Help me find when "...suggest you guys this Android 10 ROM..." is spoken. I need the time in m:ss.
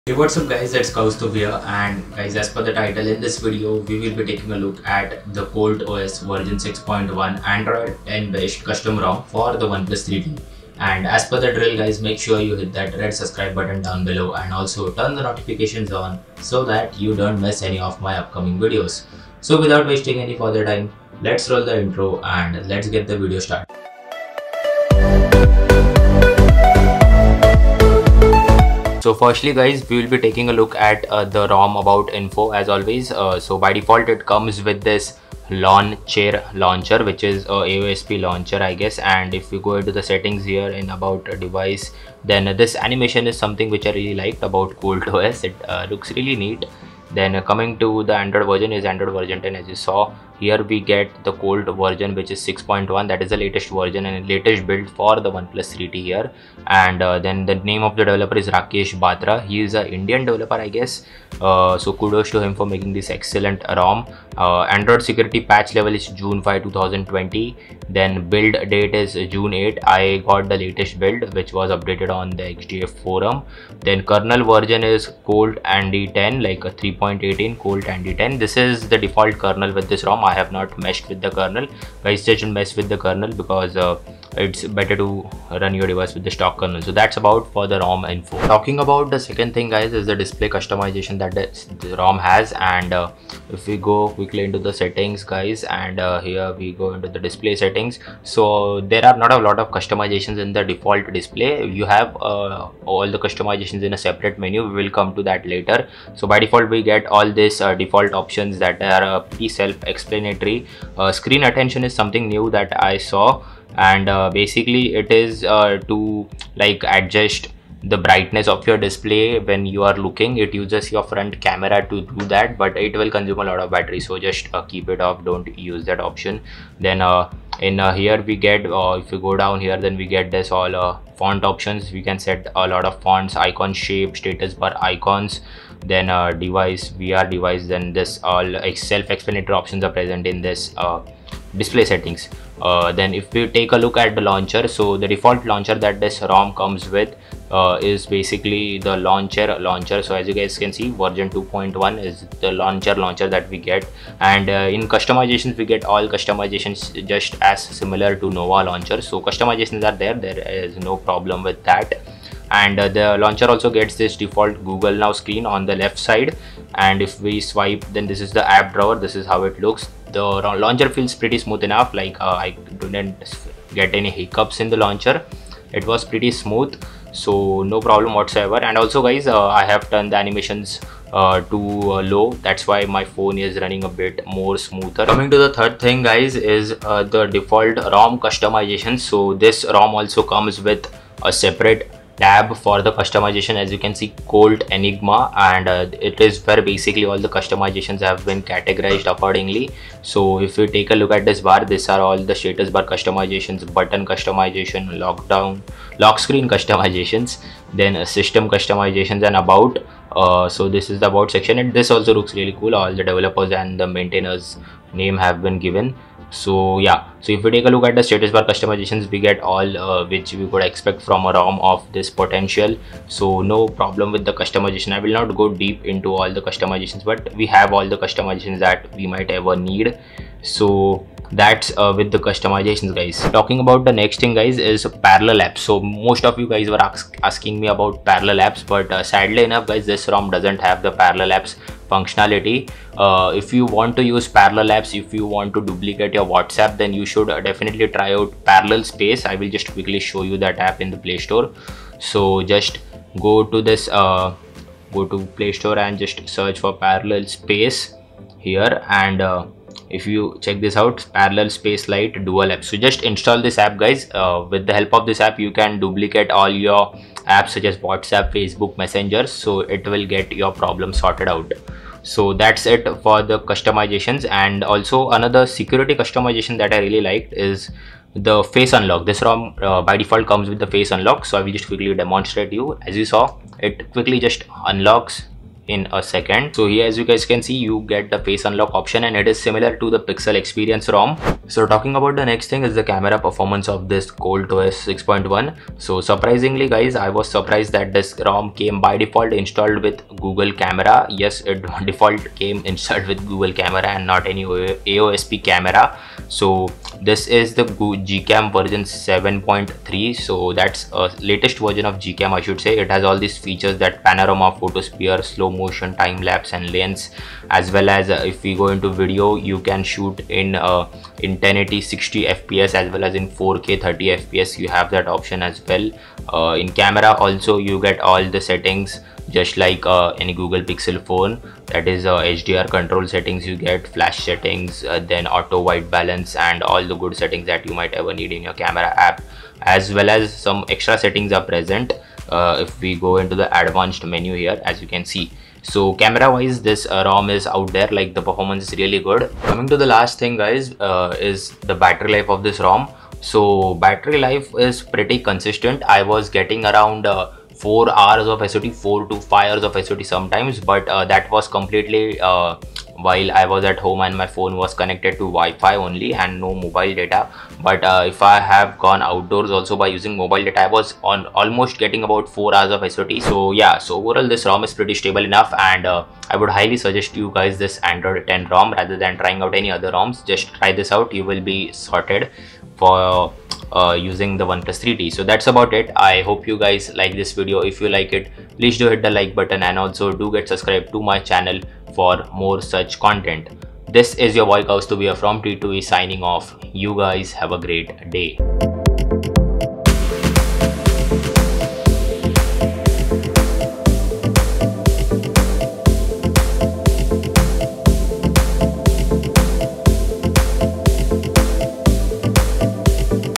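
6:16.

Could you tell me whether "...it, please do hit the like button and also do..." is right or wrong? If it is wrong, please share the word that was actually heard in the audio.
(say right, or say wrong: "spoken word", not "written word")
right.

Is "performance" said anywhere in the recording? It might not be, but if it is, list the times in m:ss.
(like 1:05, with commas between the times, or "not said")
4:53, 5:48.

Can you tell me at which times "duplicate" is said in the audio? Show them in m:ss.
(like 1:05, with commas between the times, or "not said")
4:05, 4:25.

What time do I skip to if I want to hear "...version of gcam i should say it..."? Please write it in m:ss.
5:11.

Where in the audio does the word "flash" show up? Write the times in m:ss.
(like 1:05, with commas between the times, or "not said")
5:33.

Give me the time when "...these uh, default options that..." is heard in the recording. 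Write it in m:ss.
1:47.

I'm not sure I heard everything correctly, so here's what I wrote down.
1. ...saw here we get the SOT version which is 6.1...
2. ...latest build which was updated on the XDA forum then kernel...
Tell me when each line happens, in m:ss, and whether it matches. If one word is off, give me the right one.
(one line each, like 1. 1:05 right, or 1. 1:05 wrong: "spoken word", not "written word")
1. 0:49 wrong: "Colt", not "SOT"
2. 1:10 right.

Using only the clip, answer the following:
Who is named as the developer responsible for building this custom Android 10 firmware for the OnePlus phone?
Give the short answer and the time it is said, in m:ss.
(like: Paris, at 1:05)
Rakesh Batra, at 0:58.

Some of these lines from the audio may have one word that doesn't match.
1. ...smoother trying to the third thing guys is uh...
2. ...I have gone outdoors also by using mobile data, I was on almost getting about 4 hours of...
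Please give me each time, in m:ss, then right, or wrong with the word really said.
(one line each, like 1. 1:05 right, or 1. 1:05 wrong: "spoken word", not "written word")
1. 3:04 wrong: "coming", not "trying"
2. 6:08 right.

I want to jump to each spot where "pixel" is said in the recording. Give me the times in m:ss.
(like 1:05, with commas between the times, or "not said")
4:49, 5:30.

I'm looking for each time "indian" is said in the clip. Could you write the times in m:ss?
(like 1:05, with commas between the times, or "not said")
0:59.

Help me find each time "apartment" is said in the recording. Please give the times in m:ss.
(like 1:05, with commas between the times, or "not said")
not said.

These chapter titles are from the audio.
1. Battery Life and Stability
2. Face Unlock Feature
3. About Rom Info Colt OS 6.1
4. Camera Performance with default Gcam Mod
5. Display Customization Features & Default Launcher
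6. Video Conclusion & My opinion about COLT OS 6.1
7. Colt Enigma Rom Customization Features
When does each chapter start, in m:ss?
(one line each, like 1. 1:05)
1. 5:51
2. 4:36
3. 0:29
4. 4:52
5. 1:29
6. 6:14
7. 3:10.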